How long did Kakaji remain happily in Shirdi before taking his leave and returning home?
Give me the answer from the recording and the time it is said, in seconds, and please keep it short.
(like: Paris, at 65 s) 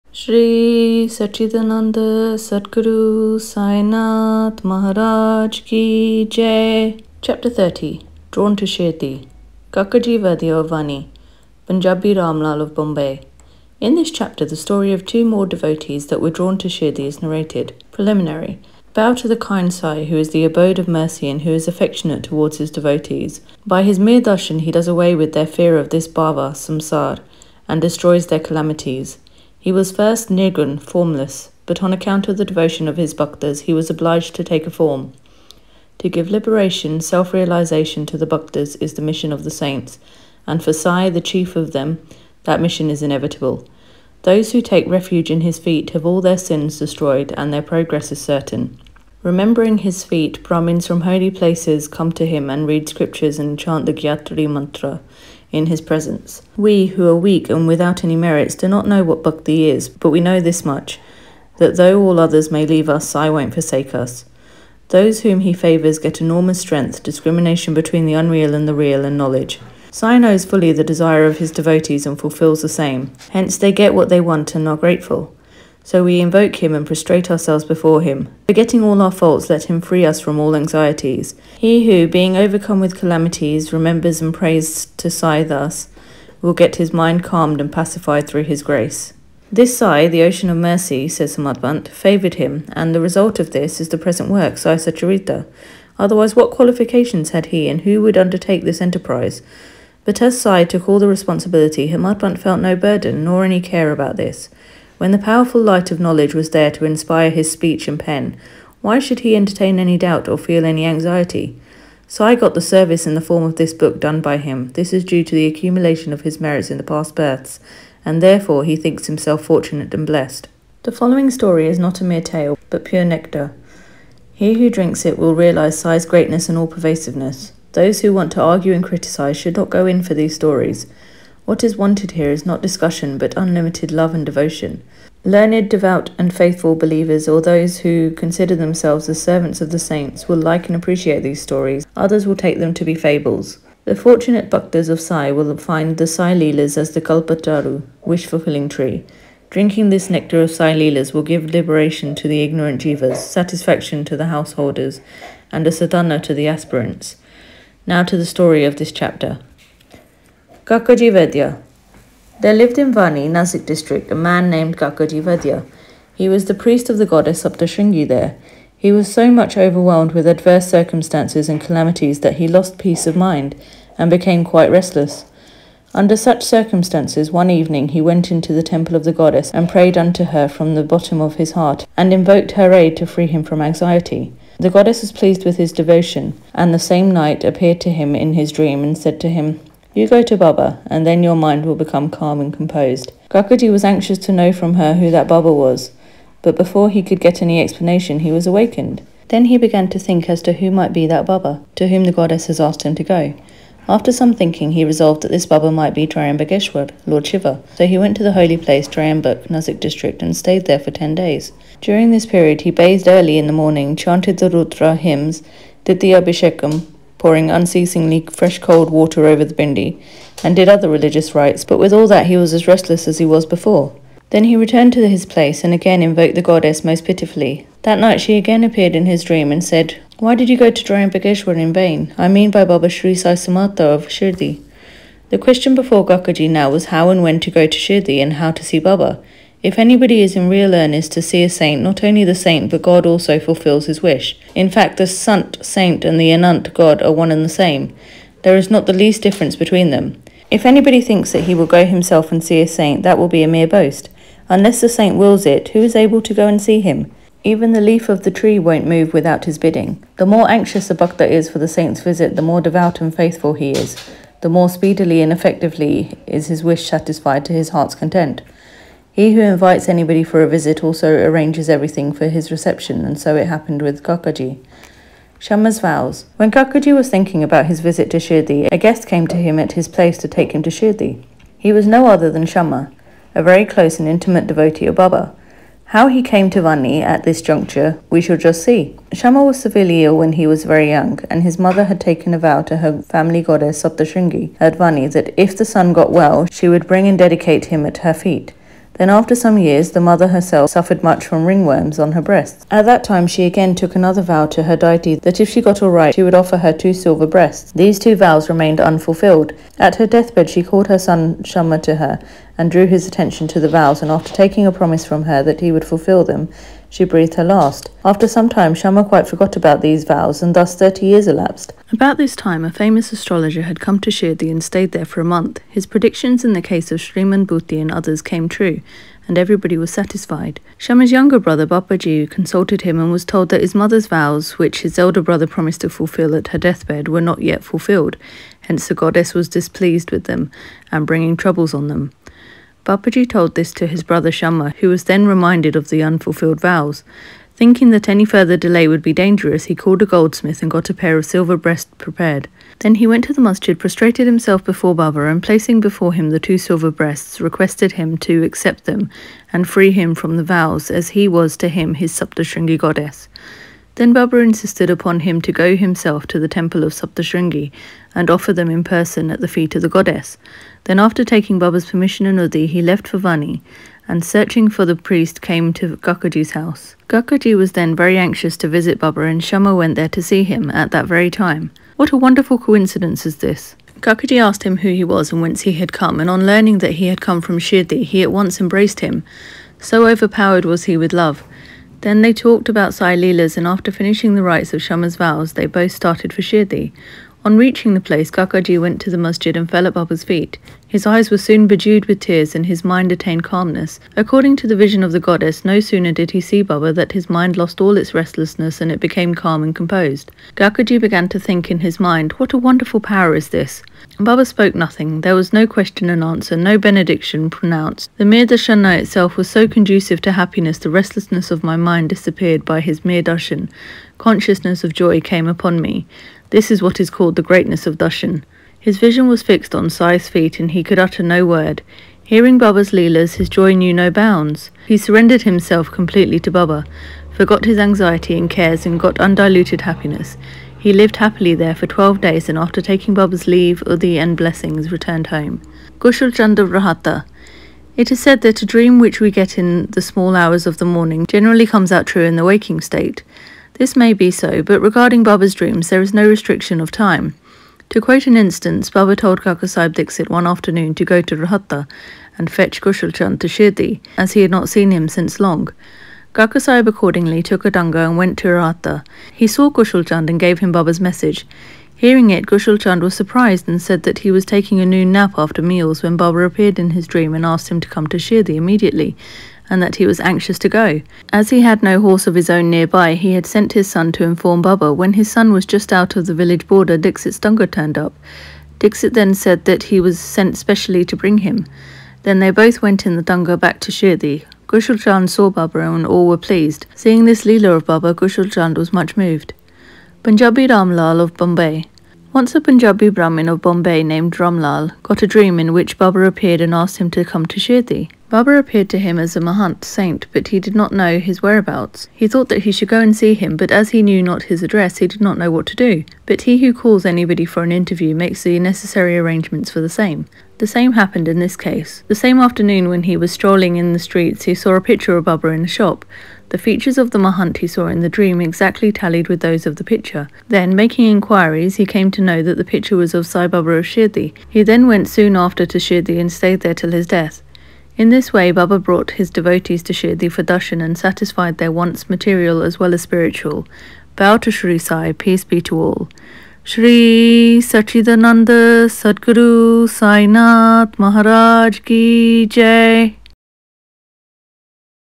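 12 days, at 441 s.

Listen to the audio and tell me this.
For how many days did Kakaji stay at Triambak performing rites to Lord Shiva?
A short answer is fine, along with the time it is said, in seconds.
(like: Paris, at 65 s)
10, at 210 s.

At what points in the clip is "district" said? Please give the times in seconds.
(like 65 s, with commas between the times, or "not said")
163 s, 209 s.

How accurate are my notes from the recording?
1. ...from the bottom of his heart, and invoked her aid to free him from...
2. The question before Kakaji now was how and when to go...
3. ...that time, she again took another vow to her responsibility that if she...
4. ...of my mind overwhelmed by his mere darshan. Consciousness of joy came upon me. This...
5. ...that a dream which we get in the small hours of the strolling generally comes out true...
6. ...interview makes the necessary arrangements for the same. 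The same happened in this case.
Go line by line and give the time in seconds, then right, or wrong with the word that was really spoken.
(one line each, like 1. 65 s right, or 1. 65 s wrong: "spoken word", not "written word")
1. 180 s right
2. 235 s right
3. 302 s wrong: "deity", not "responsibility"
4. 421 s wrong: "disappeared", not "overwhelmed"
5. 448 s wrong: "morning", not "strolling"
6. 517 s right.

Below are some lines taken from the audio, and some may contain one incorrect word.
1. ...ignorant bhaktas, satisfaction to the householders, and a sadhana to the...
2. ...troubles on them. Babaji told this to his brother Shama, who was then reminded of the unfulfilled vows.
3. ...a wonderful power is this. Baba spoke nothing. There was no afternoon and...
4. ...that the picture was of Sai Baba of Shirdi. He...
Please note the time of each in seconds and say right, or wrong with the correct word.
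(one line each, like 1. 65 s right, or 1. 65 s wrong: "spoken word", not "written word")
1. 152 s wrong: "jivas", not "bhaktas"
2. 341 s right
3. 412 s wrong: "question", not "afternoon"
4. 532 s right.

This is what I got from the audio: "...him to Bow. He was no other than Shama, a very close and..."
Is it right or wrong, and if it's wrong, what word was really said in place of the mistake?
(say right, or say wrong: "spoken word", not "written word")
wrong: "Shirdi", not "Bow".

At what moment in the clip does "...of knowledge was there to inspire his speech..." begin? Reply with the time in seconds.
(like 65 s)
105 s.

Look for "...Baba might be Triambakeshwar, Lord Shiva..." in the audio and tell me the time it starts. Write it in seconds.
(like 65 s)
205 s.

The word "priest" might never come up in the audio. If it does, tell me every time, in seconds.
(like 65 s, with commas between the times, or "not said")
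166 s, 374 s.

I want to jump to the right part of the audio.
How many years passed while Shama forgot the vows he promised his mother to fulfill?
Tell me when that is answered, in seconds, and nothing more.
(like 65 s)
320 s.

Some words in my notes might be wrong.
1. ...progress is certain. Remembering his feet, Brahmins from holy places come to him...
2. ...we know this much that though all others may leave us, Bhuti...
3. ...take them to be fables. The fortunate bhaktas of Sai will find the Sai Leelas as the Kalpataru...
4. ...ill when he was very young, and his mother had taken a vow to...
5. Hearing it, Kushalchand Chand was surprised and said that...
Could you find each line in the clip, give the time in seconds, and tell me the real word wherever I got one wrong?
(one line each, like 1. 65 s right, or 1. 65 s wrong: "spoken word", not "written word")
1. 47 s right
2. 60 s wrong: "Sai", not "Bhuti"
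3. 142 s right
4. 290 s right
5. 471 s right.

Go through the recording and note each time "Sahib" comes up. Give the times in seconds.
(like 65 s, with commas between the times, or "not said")
459 s, 466 s.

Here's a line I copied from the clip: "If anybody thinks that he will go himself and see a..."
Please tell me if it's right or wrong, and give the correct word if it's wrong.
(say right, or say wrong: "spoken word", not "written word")
right.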